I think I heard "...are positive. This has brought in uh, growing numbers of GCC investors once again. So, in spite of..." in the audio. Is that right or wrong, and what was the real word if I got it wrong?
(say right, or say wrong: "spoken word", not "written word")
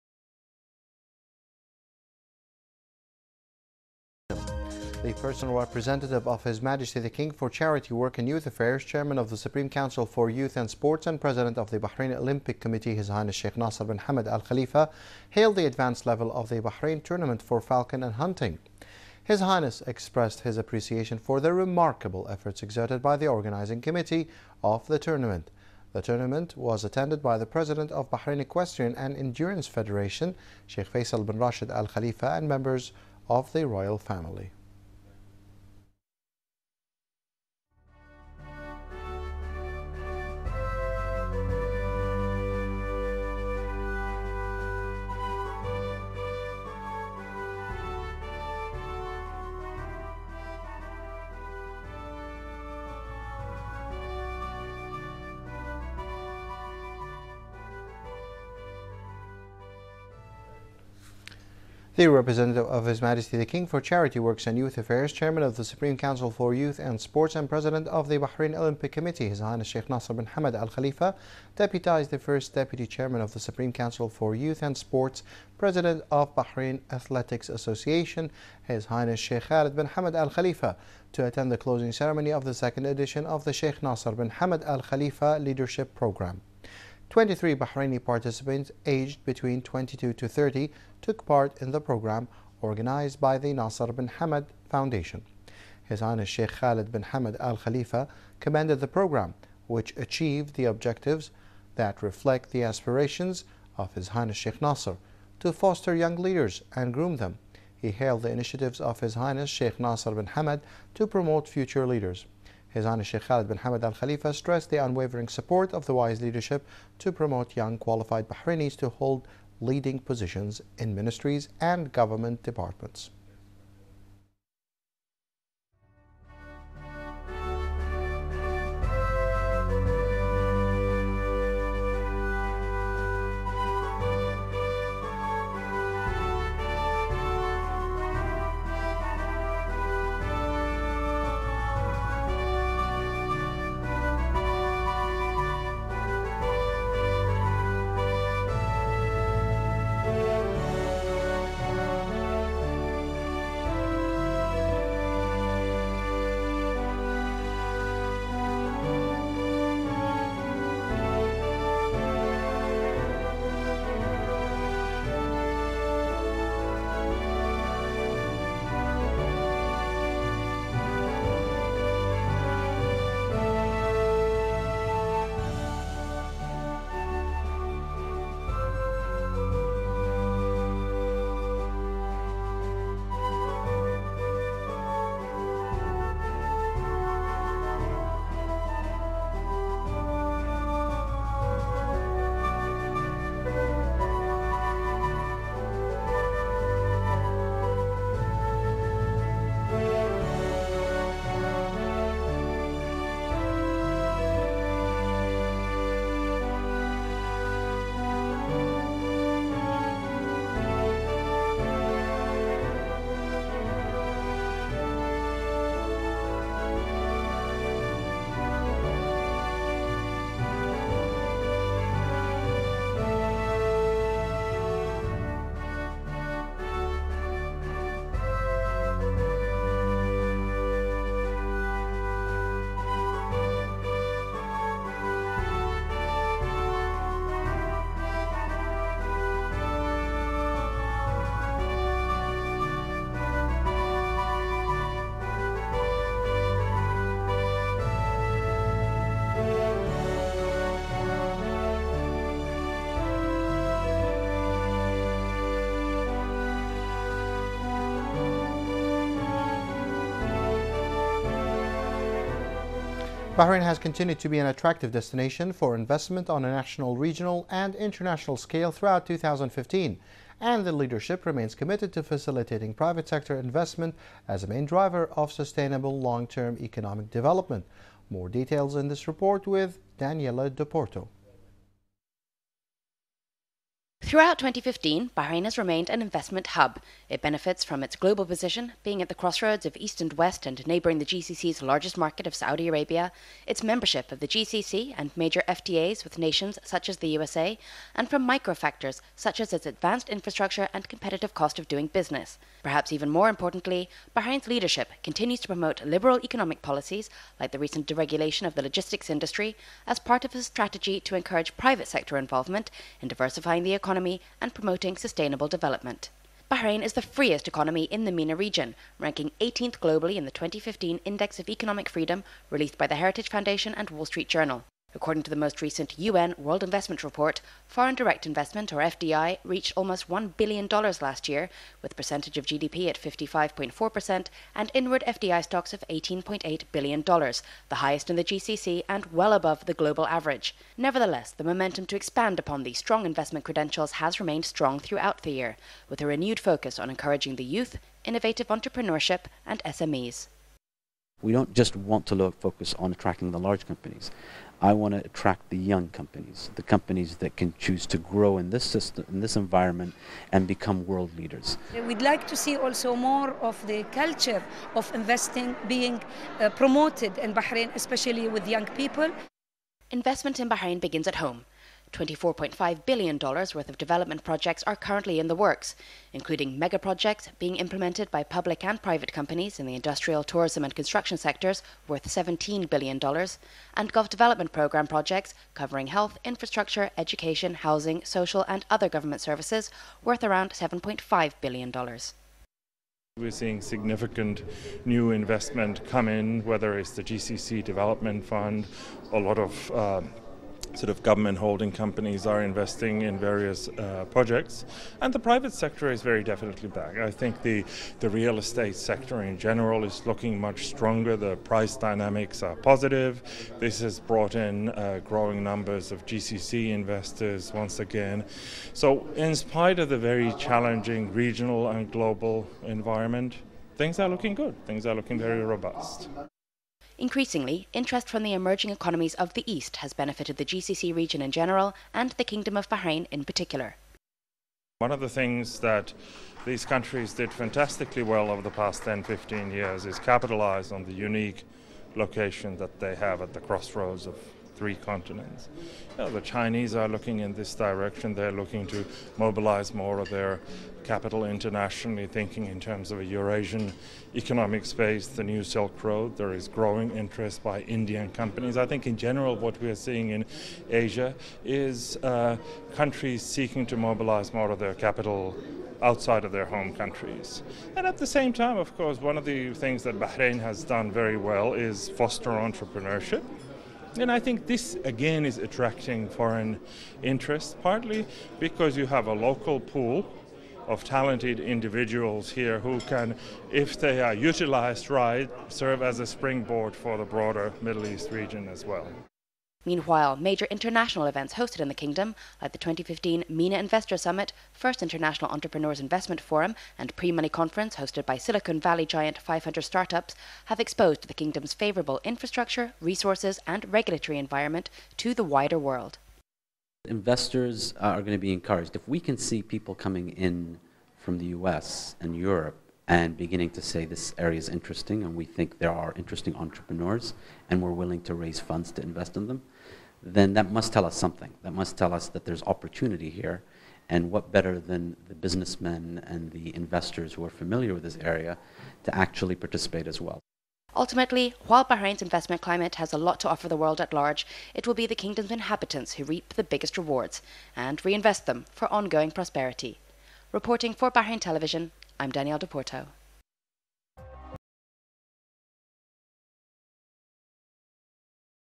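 right.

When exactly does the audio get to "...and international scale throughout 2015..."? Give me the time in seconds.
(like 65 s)
267 s.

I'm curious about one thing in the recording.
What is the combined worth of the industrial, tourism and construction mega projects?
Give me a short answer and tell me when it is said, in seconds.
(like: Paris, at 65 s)
$17 billion, at 382 s.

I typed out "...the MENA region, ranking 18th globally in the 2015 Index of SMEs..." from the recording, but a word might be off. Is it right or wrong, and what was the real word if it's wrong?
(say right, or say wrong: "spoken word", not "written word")
wrong: "Economic", not "SMEs".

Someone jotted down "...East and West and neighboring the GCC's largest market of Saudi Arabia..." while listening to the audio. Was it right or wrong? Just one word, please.
right.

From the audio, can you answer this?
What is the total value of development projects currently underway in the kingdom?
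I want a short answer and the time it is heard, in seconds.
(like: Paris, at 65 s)
$24.5 billion, at 371 s.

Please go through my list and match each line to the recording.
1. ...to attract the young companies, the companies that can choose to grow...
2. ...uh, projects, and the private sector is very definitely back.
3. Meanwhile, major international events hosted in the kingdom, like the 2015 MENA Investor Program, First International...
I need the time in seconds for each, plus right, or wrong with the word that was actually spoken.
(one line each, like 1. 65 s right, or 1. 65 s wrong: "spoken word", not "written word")
1. 354 s right
2. 403 s right
3. 489 s wrong: "Summit", not "Program".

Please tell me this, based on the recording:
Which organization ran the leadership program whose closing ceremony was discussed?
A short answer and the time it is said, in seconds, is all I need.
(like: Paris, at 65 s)
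Nasser bin Hamad Foundation, at 93 s.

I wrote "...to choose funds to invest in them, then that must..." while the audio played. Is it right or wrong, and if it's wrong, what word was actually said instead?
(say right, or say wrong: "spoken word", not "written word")
wrong: "raise", not "choose".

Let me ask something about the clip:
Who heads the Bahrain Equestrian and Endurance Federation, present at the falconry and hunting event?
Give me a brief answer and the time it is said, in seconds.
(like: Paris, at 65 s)
Sheikh Faisal bin Rashid Al Khalifa, at 30 s.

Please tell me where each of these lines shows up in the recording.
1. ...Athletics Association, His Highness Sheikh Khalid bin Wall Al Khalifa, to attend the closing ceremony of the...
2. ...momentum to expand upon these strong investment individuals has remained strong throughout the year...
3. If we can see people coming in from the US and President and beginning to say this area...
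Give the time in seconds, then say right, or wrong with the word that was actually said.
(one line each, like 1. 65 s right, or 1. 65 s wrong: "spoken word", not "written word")
1. 76 s wrong: "Hamad", not "Wall"
2. 341 s wrong: "credentials", not "individuals"
3. 508 s wrong: "Europe", not "President".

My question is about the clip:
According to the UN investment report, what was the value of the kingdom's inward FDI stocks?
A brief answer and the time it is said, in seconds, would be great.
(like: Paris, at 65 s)
$18.8 billion, at 335 s.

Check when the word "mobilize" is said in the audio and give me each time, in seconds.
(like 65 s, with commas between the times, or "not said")
449 s, 463 s.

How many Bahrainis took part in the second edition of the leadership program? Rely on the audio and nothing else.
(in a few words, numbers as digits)
23.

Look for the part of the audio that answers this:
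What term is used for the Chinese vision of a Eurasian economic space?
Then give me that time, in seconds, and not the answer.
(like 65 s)
455 s.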